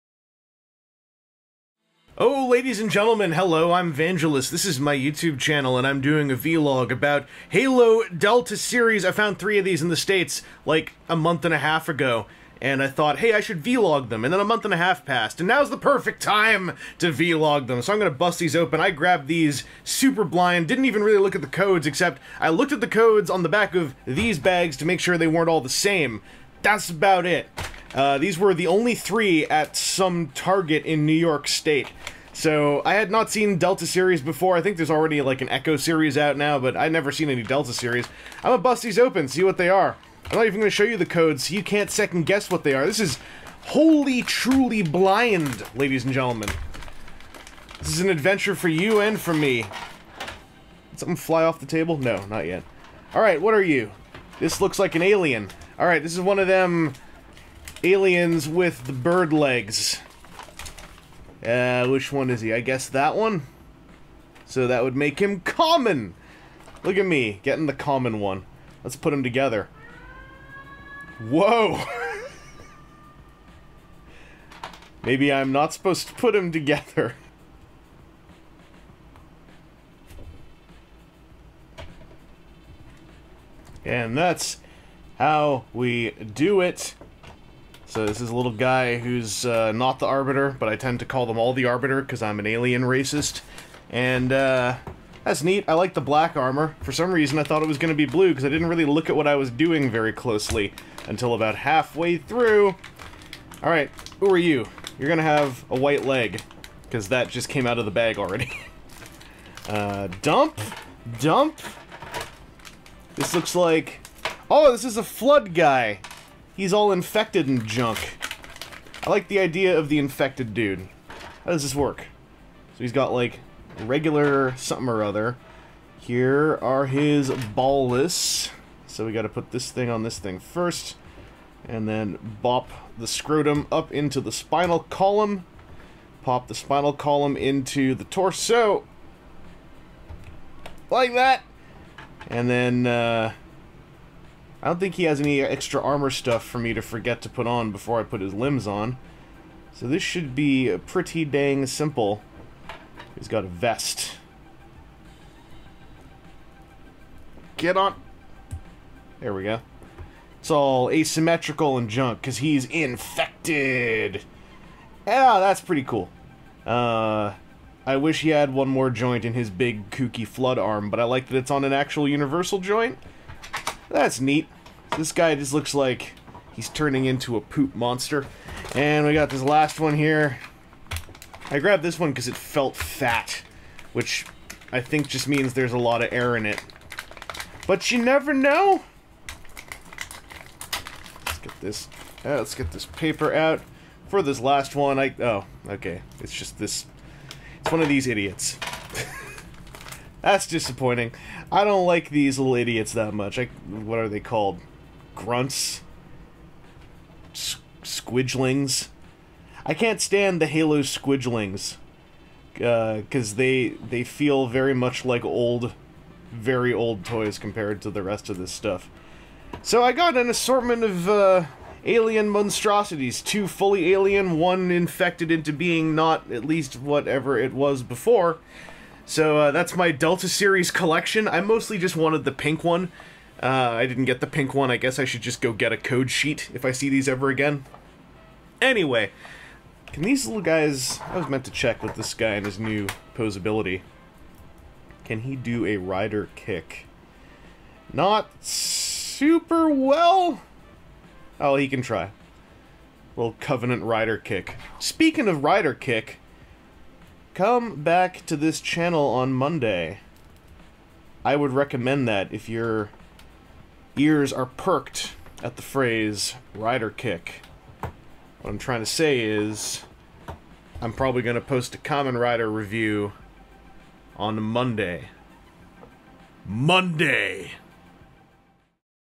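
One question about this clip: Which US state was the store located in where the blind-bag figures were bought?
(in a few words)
New York.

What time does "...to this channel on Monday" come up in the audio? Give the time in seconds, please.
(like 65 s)
258 s.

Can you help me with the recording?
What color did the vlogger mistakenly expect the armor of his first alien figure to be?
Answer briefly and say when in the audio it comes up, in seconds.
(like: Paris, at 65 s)
Blue, at 98 s.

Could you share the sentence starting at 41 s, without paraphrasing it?
So you can't second guess what they are.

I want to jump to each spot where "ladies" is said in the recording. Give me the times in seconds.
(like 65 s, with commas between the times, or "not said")
2 s, 45 s.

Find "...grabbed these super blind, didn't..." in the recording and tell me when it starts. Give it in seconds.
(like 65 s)
18 s.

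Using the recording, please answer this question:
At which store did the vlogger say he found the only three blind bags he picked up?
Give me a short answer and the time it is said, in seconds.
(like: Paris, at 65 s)
Target, at 30 s.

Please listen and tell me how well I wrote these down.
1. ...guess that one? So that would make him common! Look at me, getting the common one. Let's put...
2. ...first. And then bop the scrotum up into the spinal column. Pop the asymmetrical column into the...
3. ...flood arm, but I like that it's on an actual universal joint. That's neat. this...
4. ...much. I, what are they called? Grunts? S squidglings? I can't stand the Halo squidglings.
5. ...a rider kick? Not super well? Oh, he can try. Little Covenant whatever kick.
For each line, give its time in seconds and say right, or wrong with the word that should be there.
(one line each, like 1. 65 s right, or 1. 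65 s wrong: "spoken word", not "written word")
1. 62 s right
2. 130 s wrong: "spinal", not "asymmetrical"
3. 170 s right
4. 203 s right
5. 245 s wrong: "rider", not "whatever".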